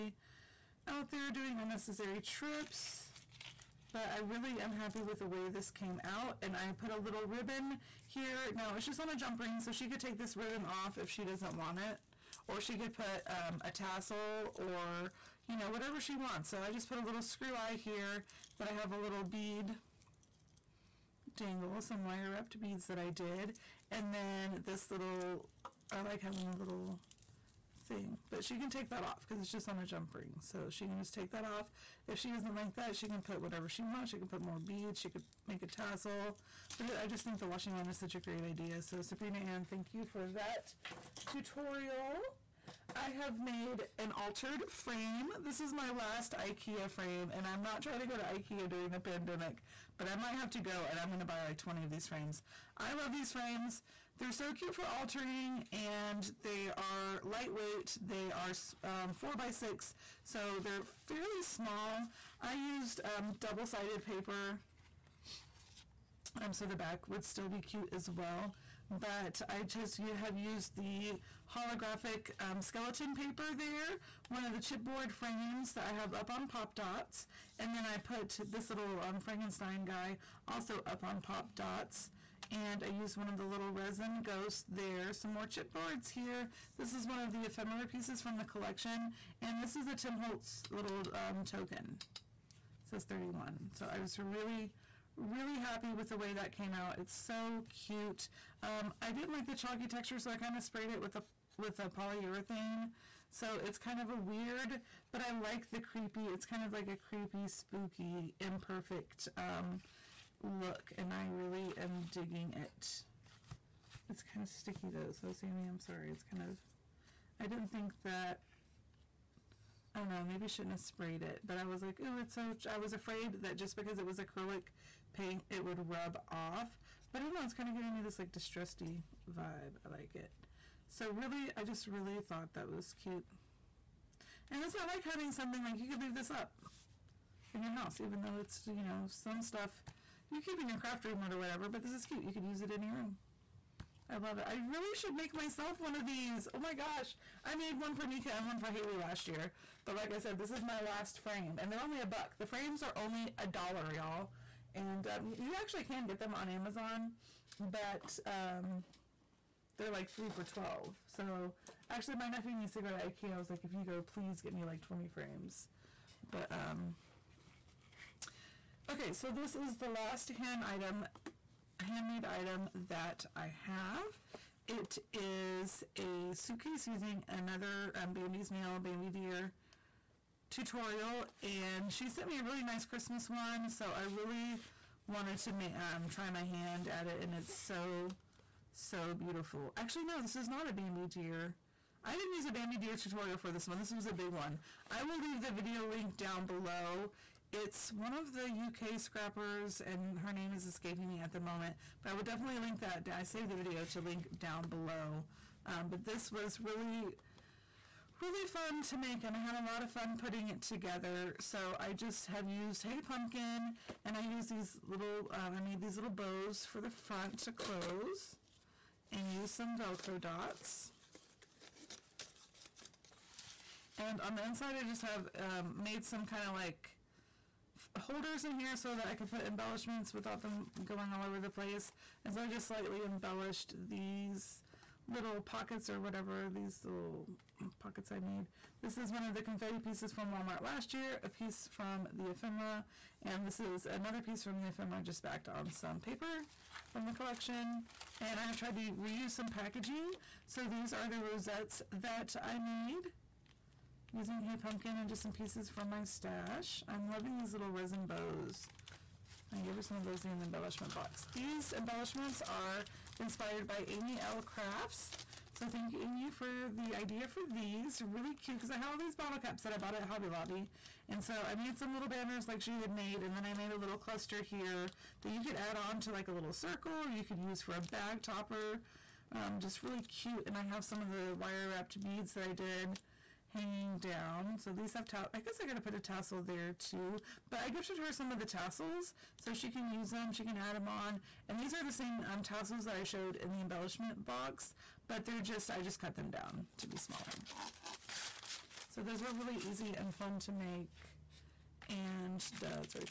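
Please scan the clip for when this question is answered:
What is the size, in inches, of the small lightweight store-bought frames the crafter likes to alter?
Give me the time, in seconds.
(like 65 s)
59 s.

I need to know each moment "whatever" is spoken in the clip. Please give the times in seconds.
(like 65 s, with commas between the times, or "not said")
15 s, 33 s, 141 s, 236 s.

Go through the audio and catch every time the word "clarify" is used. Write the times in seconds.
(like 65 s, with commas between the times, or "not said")
not said.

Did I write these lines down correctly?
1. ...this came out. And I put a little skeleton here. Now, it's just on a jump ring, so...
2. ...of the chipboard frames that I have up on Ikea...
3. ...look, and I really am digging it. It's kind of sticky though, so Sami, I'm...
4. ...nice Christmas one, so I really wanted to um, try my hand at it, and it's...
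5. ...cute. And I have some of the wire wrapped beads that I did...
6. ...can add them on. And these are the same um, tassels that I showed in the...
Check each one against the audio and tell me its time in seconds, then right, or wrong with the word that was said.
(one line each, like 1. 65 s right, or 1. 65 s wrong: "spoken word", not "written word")
1. 5 s wrong: "ribbon", not "skeleton"
2. 74 s wrong: "Pop", not "Ikea"
3. 110 s right
4. 182 s right
5. 280 s right
6. 290 s right.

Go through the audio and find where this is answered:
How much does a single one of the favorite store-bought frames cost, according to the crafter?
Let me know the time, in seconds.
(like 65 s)
153 s.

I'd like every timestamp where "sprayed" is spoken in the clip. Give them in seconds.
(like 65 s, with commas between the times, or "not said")
100 s, 120 s.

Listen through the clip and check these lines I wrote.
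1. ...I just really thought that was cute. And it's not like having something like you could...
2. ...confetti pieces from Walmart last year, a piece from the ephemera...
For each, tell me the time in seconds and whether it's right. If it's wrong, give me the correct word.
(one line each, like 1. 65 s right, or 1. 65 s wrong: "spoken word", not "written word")
1. 131 s right
2. 239 s right.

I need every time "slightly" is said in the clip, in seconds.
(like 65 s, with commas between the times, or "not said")
232 s.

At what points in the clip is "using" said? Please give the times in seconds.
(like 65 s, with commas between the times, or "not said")
176 s, 254 s.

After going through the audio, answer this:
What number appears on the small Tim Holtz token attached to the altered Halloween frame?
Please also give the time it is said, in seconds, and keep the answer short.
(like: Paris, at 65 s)
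31, at 93 s.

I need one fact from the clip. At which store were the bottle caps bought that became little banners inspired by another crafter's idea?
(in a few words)
Hobby Lobby.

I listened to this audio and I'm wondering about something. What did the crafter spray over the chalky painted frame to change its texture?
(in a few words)
polyurethane.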